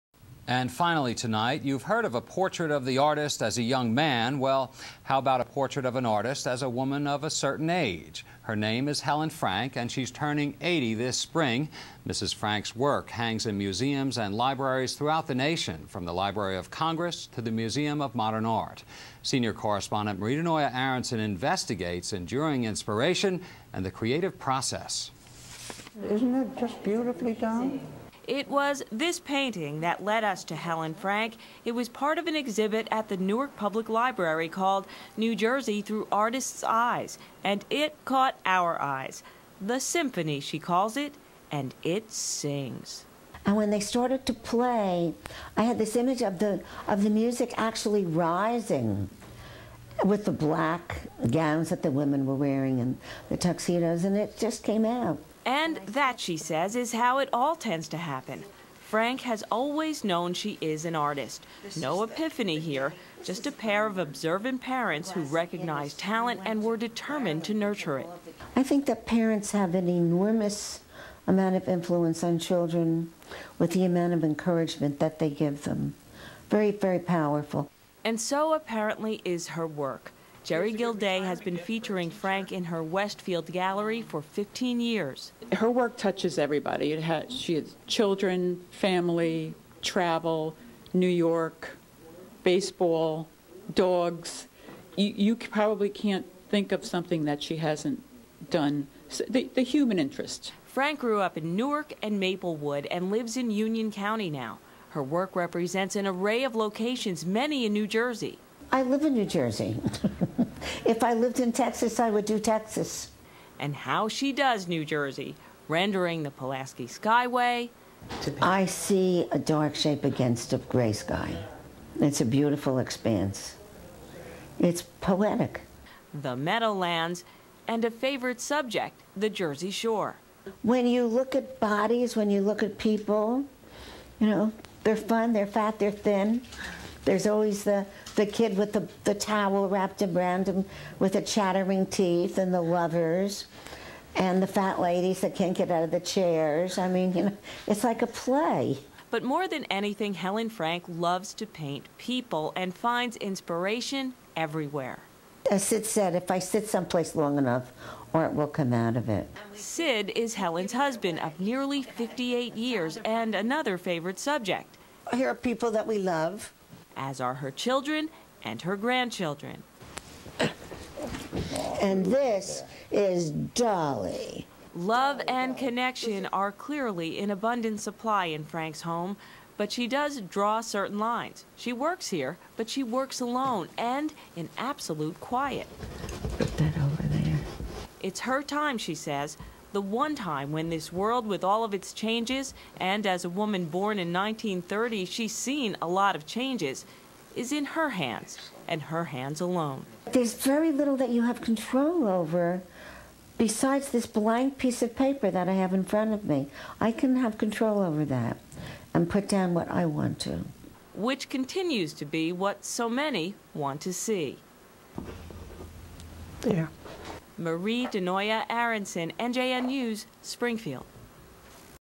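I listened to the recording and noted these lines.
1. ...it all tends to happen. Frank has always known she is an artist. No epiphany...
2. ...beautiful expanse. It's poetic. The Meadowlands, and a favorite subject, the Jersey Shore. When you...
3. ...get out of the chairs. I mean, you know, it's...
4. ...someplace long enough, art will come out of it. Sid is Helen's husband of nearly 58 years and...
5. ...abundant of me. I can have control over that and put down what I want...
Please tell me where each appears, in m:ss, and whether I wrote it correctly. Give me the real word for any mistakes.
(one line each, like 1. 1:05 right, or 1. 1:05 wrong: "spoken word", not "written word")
1. 0:57 right
2. 2:02 right
3. 2:25 right
4. 2:36 right
5. 3:25 wrong: "front", not "abundant".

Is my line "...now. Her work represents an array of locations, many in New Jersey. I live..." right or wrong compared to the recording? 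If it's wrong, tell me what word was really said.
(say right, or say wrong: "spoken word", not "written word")
right.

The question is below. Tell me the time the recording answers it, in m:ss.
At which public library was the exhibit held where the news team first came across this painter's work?
0:33.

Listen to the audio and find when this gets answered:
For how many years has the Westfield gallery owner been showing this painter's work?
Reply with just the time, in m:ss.
1:24.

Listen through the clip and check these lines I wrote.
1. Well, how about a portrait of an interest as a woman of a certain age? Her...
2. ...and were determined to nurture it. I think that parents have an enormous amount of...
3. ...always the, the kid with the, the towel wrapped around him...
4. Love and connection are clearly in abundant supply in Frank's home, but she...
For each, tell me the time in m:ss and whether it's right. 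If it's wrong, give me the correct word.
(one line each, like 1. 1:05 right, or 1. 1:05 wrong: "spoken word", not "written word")
1. 0:04 wrong: "artist", not "interest"
2. 1:06 right
3. 2:17 right
4. 2:54 right.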